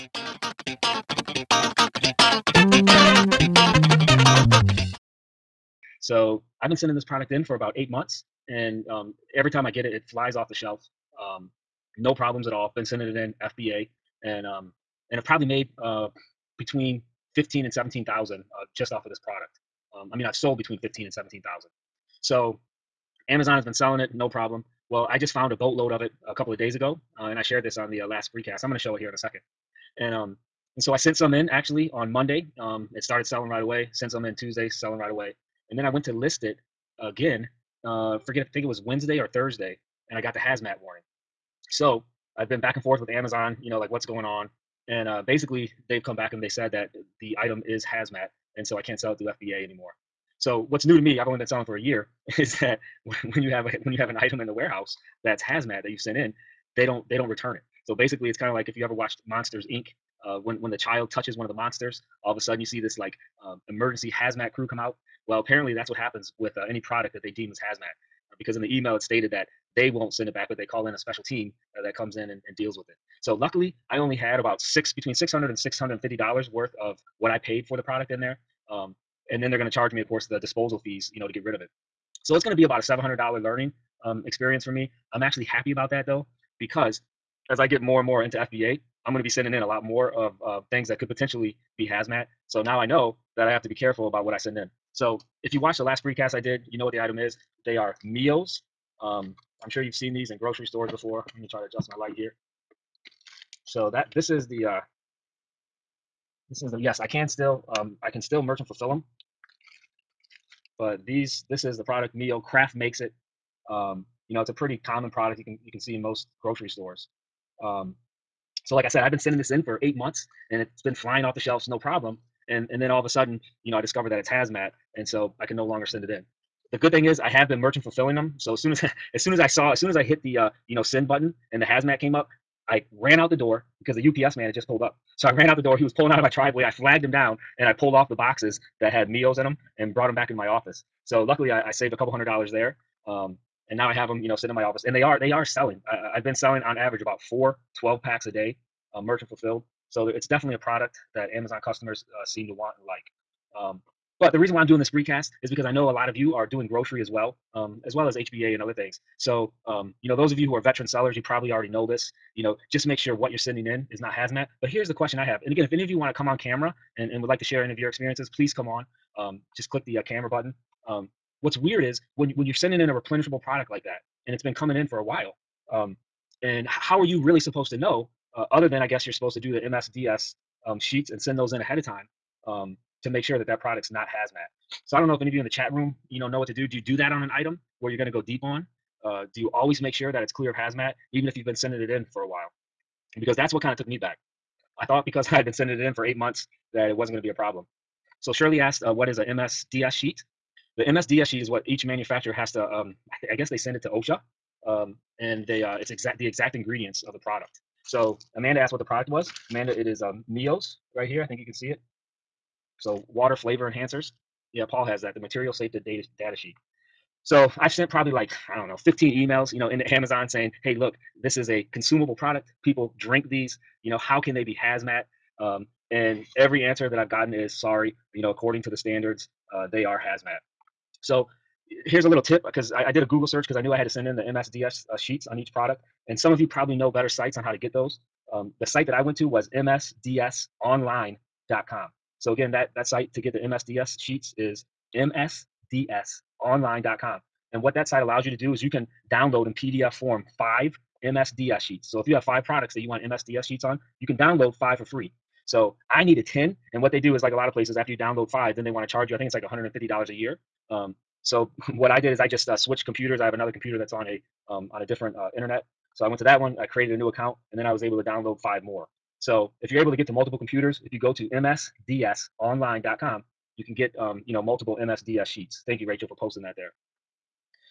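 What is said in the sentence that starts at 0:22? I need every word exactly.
So Amazon has been selling it, no problem.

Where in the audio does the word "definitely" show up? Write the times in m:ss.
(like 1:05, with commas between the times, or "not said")
2:30.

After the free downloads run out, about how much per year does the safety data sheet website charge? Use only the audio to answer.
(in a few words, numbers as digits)
$150.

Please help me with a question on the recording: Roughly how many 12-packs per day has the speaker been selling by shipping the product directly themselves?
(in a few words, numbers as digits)
4.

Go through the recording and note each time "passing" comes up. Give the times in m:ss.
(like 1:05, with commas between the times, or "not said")
not said.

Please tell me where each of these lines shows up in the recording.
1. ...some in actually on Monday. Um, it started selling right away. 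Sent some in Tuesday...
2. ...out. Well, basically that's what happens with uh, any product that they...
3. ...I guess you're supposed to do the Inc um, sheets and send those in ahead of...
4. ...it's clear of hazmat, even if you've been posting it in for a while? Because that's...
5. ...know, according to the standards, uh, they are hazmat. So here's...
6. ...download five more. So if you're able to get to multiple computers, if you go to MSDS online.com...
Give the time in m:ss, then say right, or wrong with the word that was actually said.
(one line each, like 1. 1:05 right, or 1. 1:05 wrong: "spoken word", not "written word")
1. 0:31 right
2. 1:04 wrong: "apparently", not "basically"
3. 2:58 wrong: "MSDS", not "Inc"
4. 3:10 wrong: "sending", not "posting"
5. 3:48 right
6. 4:28 right.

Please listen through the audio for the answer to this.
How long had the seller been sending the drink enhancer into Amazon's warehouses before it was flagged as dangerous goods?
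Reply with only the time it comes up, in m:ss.
0:07.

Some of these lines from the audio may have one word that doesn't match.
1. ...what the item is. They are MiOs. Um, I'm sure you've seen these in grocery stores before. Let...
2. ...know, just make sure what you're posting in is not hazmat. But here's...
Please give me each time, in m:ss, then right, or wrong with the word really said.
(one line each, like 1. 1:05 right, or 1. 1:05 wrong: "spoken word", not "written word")
1. 1:36 right
2. 2:42 wrong: "sending", not "posting".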